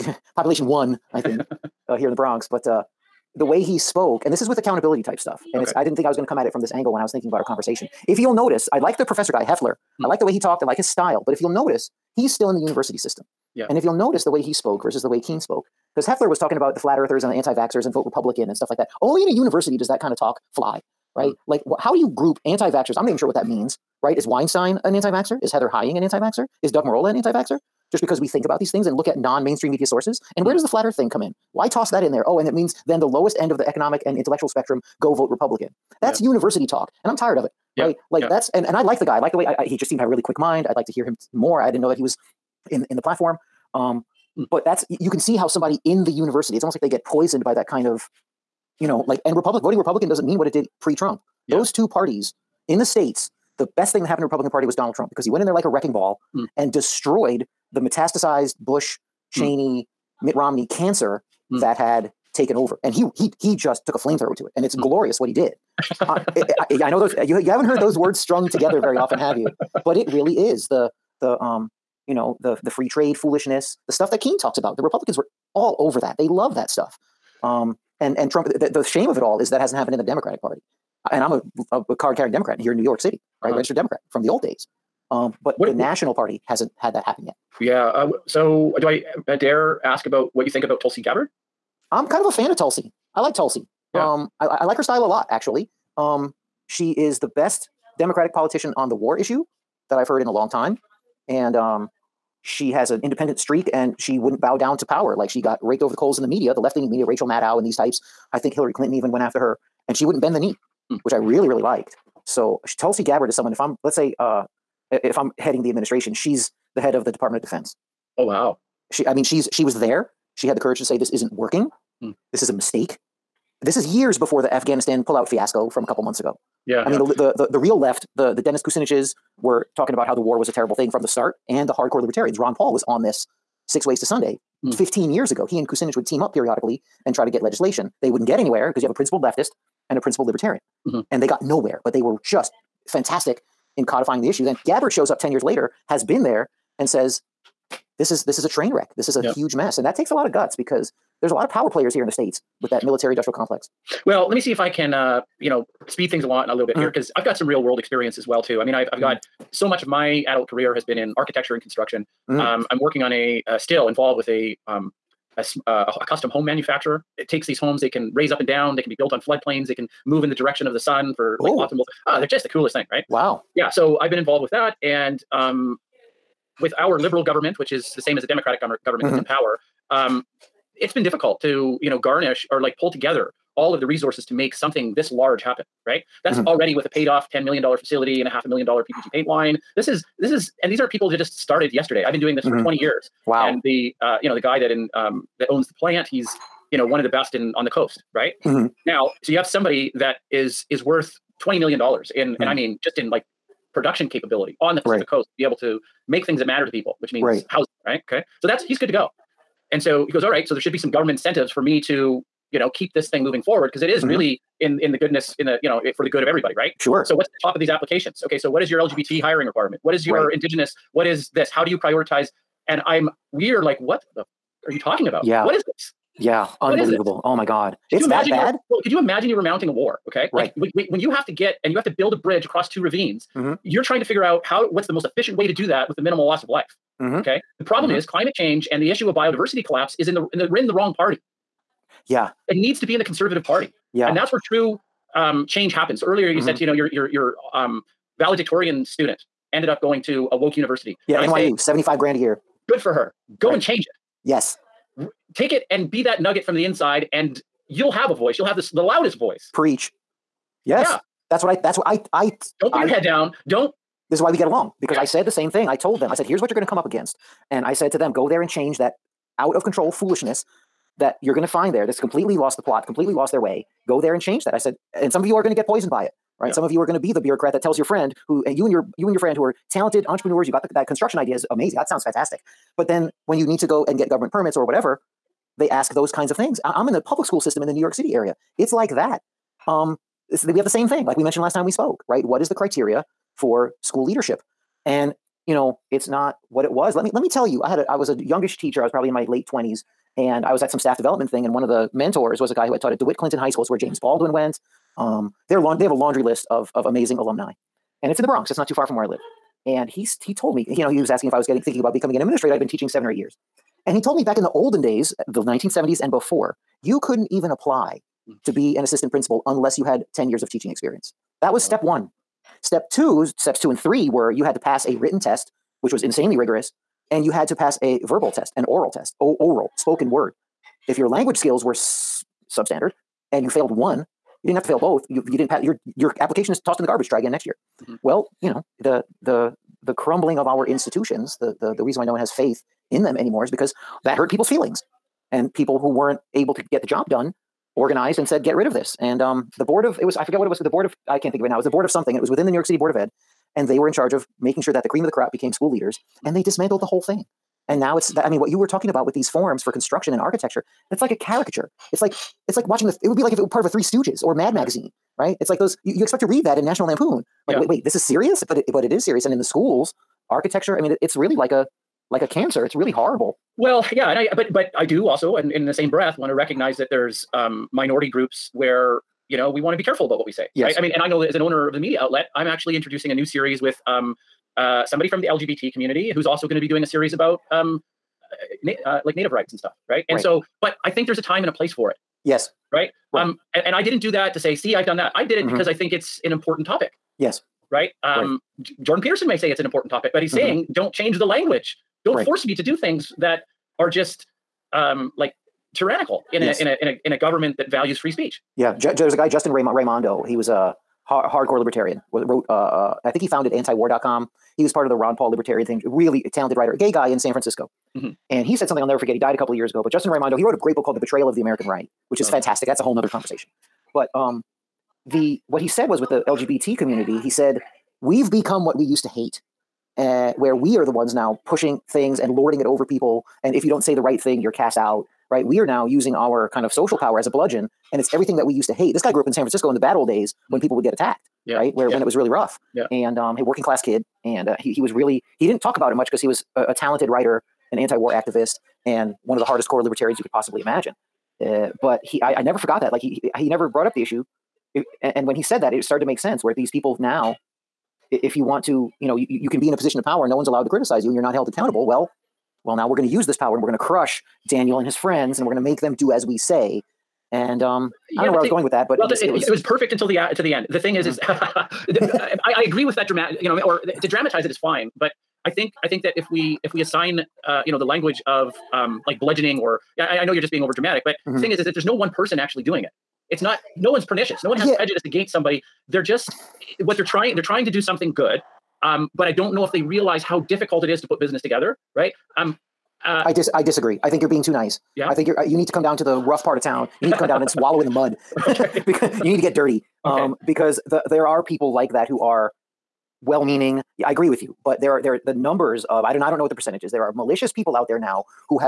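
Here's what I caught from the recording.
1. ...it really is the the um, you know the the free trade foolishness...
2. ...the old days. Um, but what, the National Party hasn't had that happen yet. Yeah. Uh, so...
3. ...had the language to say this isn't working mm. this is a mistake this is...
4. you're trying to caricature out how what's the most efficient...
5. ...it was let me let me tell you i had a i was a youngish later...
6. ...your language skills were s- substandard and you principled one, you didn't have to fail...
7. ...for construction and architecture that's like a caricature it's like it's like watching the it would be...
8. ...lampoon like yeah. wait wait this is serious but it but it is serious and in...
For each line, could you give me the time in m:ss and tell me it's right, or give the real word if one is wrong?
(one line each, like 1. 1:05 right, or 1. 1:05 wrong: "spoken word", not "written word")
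1. 1:09 right
2. 1:24 right
3. 2:00 wrong: "courage", not "language"
4. 3:53 wrong: "figure", not "caricature"
5. 4:56 wrong: "teacher", not "later"
6. 5:30 wrong: "failed", not "principled"
7. 5:59 right
8. 6:06 right.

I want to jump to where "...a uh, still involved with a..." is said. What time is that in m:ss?
2:43.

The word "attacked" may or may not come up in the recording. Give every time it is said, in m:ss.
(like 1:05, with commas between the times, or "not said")
7:20.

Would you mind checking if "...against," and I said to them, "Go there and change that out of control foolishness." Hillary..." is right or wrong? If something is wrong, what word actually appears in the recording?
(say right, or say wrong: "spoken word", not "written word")
wrong: "That", not "Hillary".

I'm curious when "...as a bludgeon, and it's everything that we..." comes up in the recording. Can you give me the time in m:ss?
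7:17.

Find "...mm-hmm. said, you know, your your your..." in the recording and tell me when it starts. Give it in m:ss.
4:06.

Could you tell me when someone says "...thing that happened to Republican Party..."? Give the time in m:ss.
0:53.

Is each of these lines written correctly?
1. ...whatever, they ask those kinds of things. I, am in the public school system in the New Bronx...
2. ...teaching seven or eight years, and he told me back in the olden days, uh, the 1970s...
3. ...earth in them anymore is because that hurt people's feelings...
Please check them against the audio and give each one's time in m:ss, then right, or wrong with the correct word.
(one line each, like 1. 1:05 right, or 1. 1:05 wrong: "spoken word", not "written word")
1. 4:44 wrong: "York", not "Bronx"
2. 5:12 right
3. 5:42 wrong: "faith", not "earth".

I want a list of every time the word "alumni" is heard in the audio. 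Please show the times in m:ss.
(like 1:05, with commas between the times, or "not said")
5:07.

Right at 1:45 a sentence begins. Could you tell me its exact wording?
Like she got raked over the coals in the media, the left leaning media, Rachel Maddow and these types.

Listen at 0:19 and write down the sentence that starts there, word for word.
Only in a university does that kind of talk fly, right?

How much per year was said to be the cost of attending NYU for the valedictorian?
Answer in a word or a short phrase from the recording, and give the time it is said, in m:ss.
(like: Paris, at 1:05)
seventy-five grand, at 4:11.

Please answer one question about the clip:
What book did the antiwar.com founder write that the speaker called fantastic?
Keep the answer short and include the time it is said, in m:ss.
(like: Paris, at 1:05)
The Betrayal of the American Right, at 7:00.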